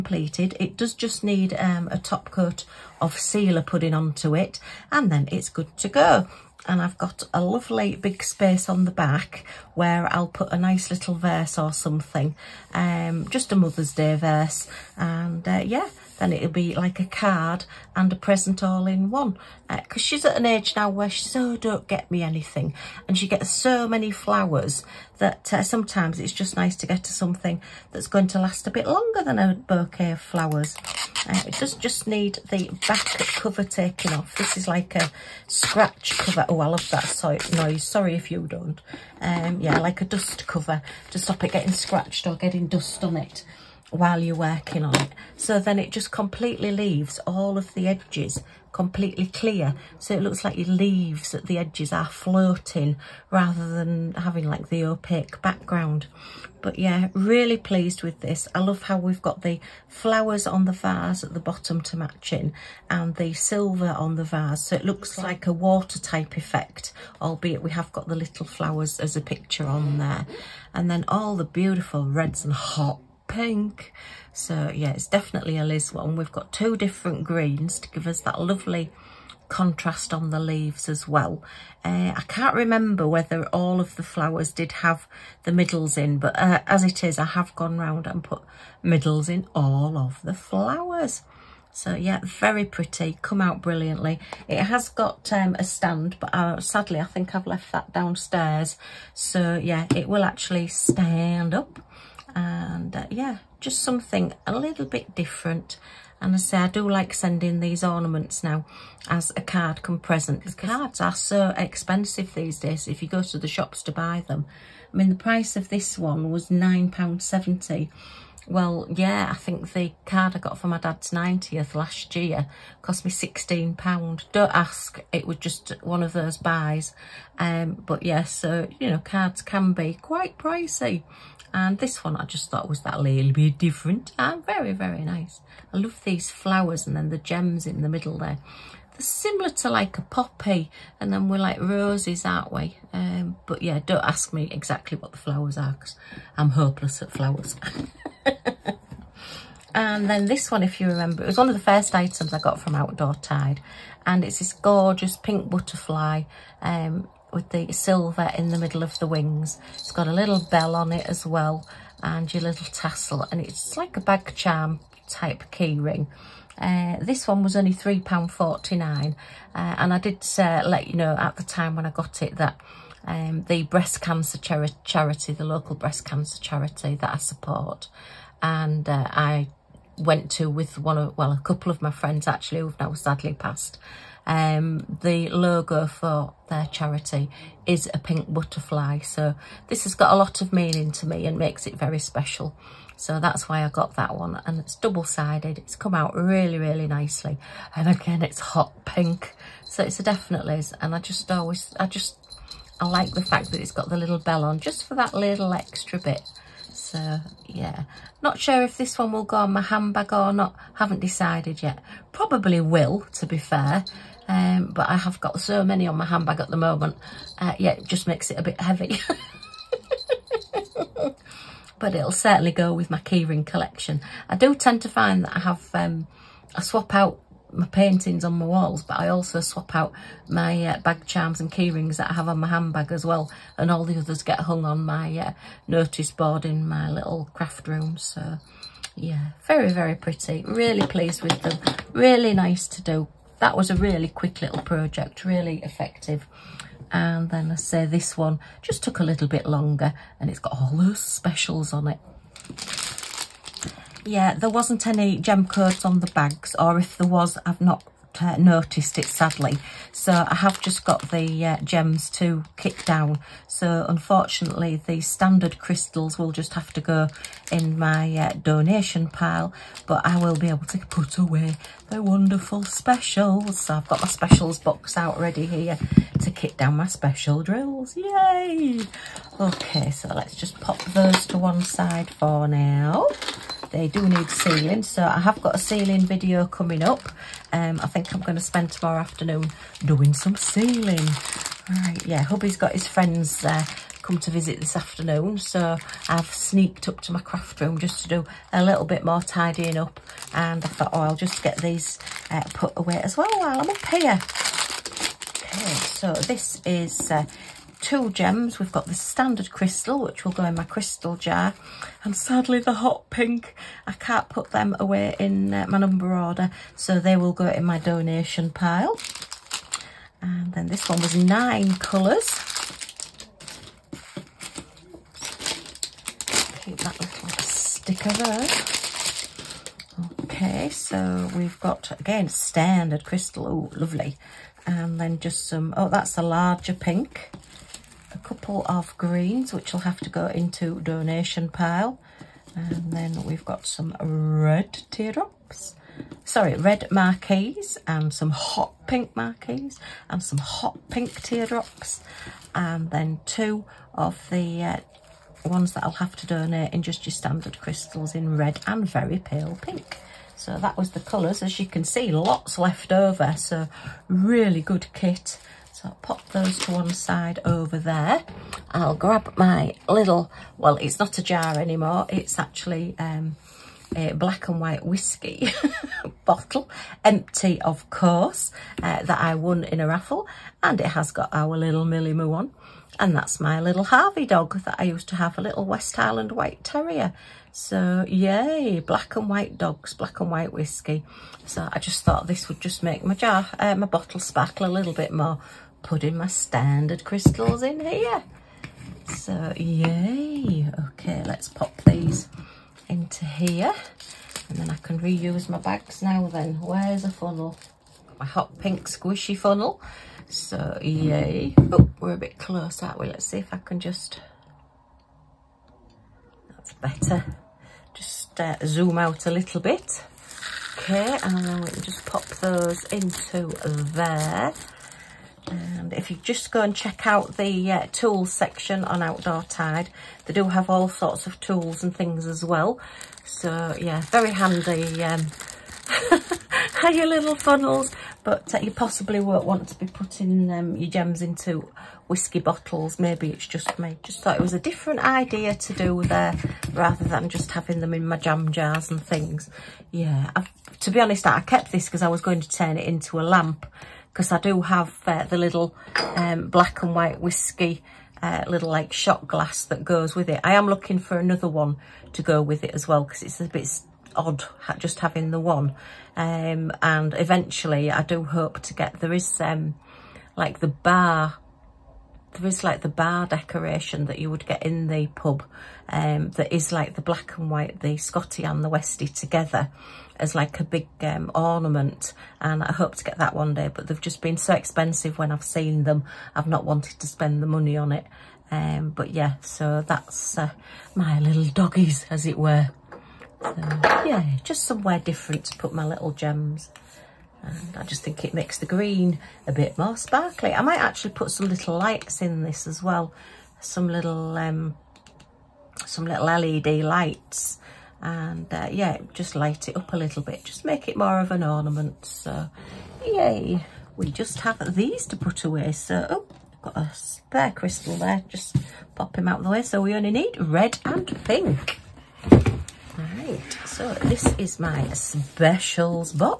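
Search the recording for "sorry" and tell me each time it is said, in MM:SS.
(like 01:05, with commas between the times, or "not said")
00:37, 05:46.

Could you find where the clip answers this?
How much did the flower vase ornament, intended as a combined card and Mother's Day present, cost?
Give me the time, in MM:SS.
01:56.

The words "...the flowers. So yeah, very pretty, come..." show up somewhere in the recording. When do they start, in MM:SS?
01:30.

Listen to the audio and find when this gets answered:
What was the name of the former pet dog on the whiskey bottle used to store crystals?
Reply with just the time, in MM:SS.
06:23.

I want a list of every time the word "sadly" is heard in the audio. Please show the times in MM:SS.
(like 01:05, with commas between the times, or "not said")
01:36, 03:02, 04:19, 05:12.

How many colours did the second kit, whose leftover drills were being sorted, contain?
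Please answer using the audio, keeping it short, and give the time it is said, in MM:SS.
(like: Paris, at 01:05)
Nine, at 05:21.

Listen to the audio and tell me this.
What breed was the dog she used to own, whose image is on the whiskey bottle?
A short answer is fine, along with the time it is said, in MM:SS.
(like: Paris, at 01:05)
West Highland White Terrier, at 06:25.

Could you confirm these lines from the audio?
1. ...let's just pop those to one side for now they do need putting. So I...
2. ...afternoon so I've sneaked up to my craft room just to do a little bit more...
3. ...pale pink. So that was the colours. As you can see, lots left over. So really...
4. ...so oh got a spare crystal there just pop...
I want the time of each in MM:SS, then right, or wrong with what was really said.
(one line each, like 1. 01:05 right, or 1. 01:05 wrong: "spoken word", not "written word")
1. 04:40 wrong: "sealing", not "putting"
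2. 04:54 right
3. 05:59 right
4. 08:35 right.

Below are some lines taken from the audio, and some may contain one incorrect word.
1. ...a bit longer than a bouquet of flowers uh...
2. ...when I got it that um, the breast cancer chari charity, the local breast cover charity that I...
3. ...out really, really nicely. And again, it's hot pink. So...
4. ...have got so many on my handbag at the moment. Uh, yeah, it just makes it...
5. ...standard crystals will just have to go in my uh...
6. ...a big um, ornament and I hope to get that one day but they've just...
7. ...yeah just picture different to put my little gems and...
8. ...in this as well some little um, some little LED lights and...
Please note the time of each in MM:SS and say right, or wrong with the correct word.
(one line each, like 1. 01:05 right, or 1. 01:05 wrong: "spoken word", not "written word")
1. 00:28 right
2. 02:51 wrong: "cancer", not "cover"
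3. 03:15 right
4. 03:34 right
5. 04:24 right
6. 08:00 right
7. 08:14 wrong: "somewhere", not "picture"
8. 08:22 right.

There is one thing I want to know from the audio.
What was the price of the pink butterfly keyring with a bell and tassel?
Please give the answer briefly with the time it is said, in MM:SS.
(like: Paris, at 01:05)
£3.49, at 02:47.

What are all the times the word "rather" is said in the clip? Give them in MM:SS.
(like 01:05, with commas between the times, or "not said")
00:53, 07:26.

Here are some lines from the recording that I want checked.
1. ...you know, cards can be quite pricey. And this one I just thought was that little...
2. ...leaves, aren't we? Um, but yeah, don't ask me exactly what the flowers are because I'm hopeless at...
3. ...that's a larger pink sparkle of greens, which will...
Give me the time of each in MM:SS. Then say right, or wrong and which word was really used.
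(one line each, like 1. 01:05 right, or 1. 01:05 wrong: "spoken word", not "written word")
1. 02:08 right
2. 02:21 wrong: "roses", not "leaves"
3. 05:35 wrong: "couple", not "sparkle".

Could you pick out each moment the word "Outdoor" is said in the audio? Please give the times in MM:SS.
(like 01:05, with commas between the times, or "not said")
02:32, 07:09.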